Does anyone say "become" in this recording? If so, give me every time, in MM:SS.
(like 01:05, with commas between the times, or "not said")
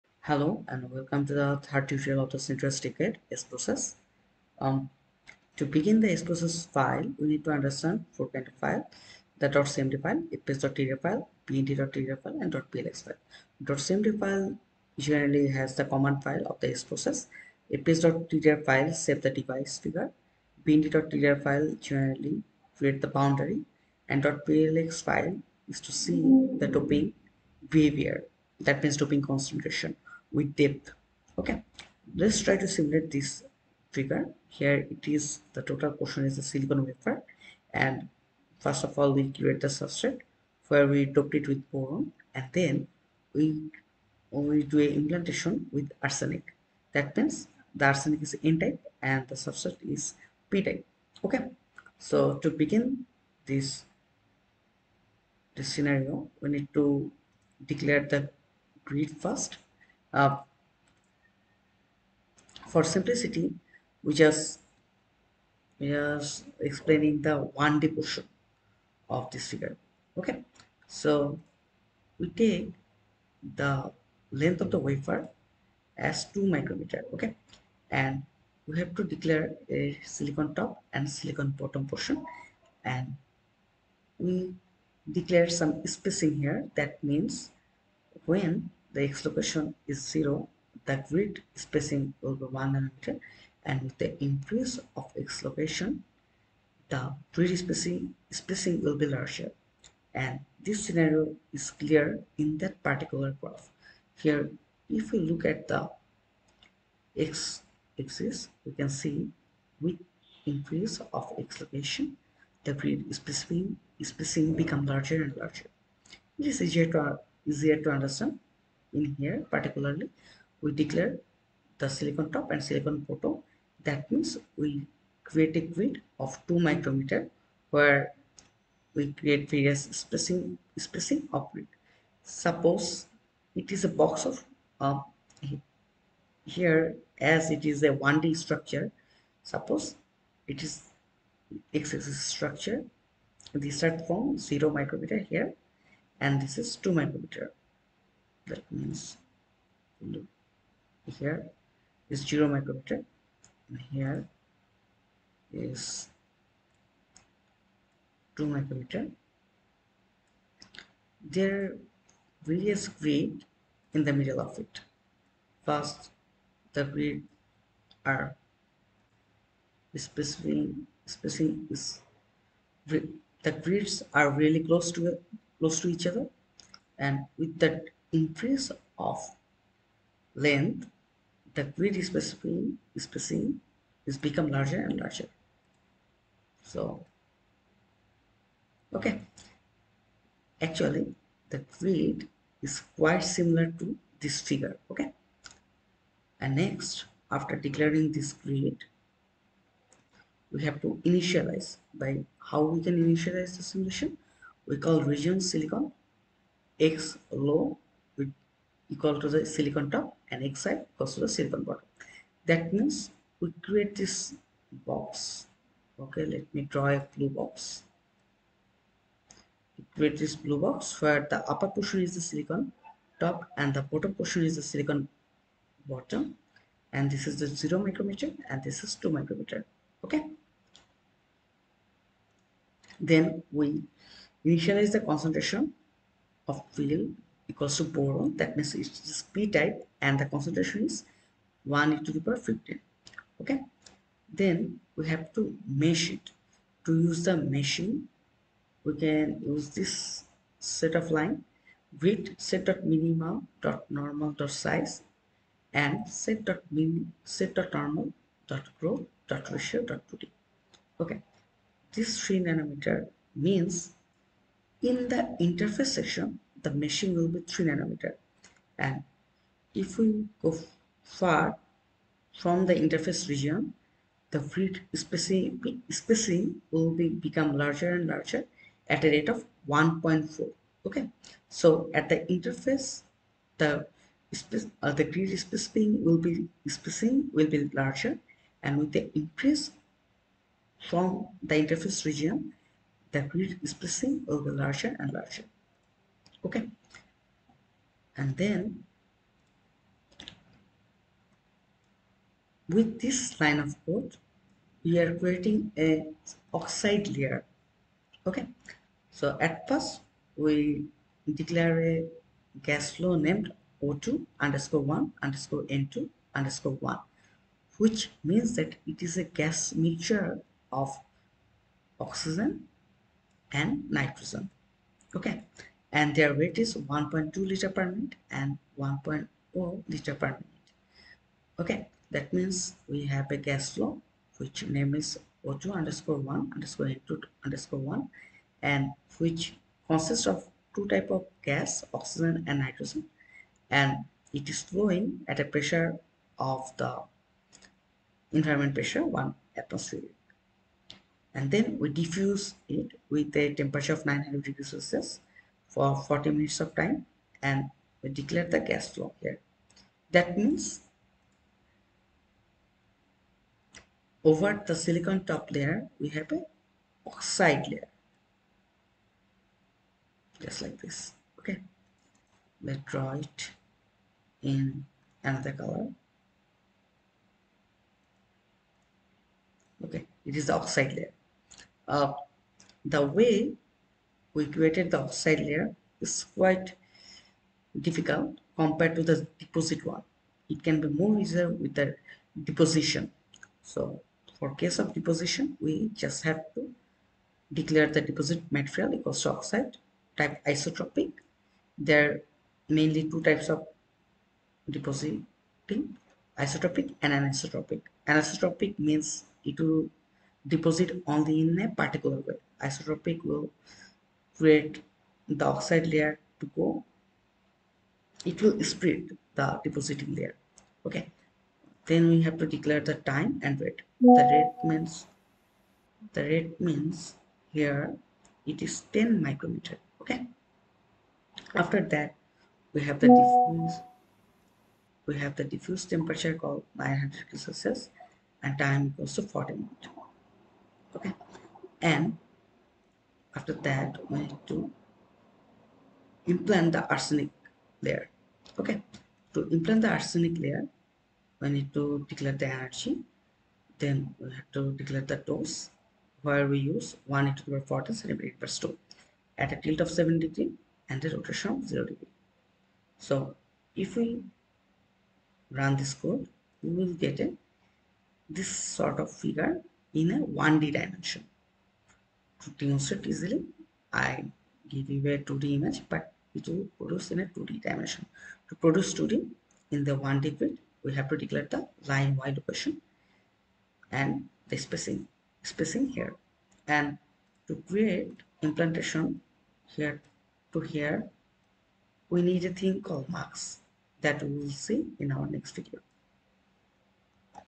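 01:54, 03:04, 04:37.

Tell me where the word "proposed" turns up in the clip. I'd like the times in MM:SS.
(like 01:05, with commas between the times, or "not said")
not said.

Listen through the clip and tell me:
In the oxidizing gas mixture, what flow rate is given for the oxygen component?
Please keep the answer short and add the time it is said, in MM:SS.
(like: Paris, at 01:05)
1.2 liters per minute, at 05:26.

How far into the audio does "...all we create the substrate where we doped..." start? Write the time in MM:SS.
00:38.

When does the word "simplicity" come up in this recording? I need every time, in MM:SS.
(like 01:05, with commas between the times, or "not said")
01:02.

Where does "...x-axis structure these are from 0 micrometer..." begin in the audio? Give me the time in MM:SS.
02:21.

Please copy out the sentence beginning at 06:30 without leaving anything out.
It can be more easier with the deposition.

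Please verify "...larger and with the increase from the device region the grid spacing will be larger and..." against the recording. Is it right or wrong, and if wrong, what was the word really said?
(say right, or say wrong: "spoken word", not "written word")
wrong: "interface", not "device".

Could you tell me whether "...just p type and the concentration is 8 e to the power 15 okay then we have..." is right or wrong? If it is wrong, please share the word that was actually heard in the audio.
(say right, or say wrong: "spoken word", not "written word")
wrong: "1", not "8".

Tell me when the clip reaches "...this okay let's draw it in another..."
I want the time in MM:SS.
06:10.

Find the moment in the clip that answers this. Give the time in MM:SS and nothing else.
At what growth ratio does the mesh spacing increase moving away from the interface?
04:39.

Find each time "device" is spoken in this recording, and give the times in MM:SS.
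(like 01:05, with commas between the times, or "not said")
00:19.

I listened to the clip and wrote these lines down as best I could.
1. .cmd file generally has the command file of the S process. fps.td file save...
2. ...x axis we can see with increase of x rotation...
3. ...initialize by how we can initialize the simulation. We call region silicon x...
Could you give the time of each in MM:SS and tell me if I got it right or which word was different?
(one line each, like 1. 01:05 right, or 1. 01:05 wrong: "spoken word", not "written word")
1. 00:13 right
2. 01:47 wrong: "location", not "rotation"
3. 03:21 right.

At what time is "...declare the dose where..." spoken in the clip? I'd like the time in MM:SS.
07:34.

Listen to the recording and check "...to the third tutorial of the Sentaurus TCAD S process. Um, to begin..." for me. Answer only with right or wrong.
right.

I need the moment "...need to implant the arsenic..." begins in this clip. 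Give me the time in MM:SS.
07:24.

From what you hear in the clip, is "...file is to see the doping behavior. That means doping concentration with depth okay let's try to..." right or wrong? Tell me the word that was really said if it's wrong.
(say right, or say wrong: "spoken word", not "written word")
right.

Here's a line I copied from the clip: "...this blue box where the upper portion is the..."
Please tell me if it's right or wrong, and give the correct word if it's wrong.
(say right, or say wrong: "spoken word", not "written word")
right.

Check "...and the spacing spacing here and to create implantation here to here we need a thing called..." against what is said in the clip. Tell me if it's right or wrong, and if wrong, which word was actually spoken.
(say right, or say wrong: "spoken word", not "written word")
right.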